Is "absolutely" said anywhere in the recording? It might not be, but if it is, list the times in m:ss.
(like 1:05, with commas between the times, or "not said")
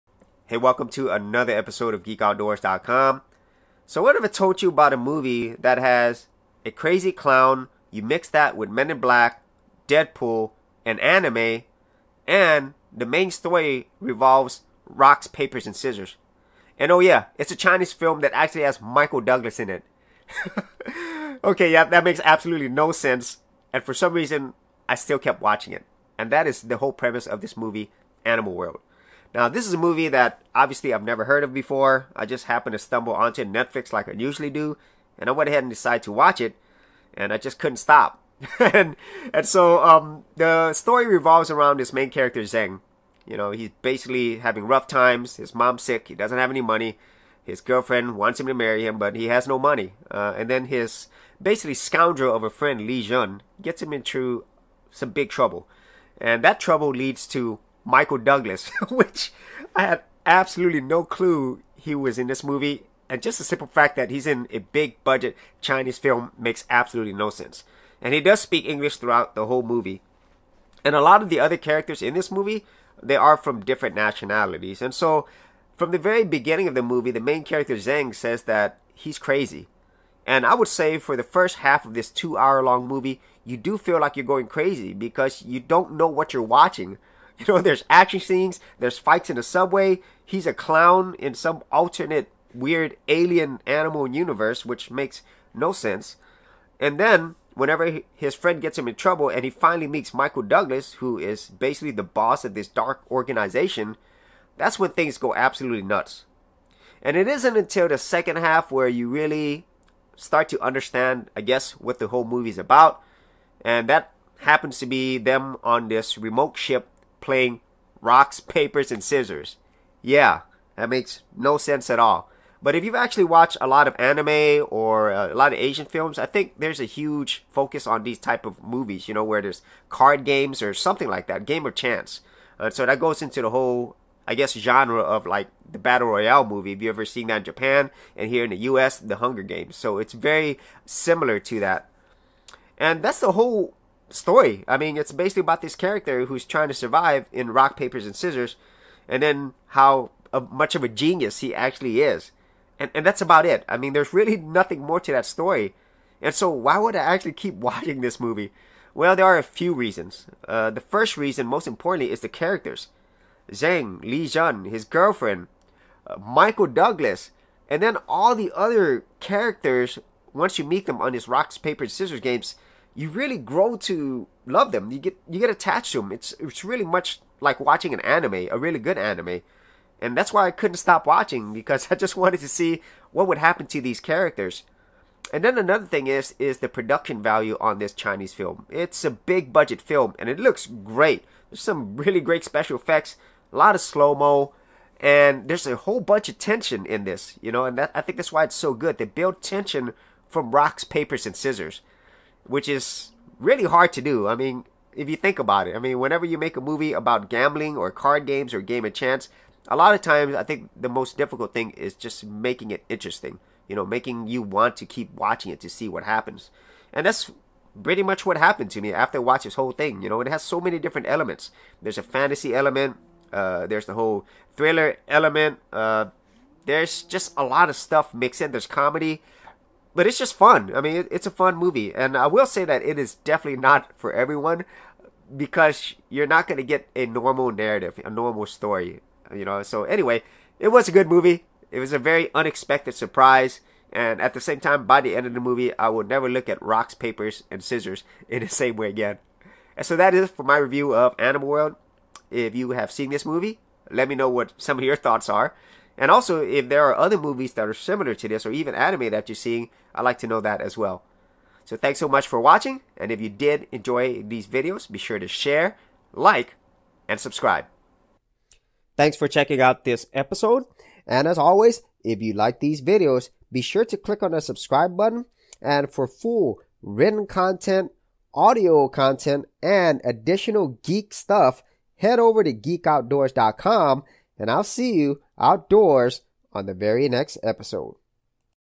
0:22, 1:00, 1:06, 1:45.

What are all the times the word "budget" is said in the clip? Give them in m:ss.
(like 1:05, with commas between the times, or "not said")
1:05, 3:09.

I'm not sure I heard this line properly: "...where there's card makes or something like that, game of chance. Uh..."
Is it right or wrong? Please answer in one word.
wrong.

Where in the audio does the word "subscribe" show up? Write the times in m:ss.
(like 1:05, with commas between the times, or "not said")
4:27, 4:34.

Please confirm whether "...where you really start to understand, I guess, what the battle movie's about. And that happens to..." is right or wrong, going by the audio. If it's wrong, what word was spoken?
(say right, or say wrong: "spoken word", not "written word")
wrong: "whole", not "battle".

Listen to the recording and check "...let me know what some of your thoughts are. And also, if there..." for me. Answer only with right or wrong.
right.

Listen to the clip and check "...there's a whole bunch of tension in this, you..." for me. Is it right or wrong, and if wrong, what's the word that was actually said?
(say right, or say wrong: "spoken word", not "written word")
right.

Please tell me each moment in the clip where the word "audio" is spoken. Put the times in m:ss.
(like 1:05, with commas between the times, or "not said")
4:38.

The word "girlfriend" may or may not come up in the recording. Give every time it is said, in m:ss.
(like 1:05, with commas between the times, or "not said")
0:47, 2:44.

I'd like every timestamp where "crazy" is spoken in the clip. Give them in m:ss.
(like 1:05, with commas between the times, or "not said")
0:06, 1:19, 1:24.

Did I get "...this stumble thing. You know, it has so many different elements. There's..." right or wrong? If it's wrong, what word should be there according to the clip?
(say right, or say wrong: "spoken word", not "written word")
wrong: "whole", not "stumble".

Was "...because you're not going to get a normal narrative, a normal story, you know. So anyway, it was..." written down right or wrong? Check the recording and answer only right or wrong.
right.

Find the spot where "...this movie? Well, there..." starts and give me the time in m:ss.
2:38.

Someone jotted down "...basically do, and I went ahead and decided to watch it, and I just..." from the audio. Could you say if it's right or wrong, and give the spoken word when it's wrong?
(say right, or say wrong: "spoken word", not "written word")
wrong: "usually", not "basically".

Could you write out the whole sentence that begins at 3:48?
There's comedy but it's just fun.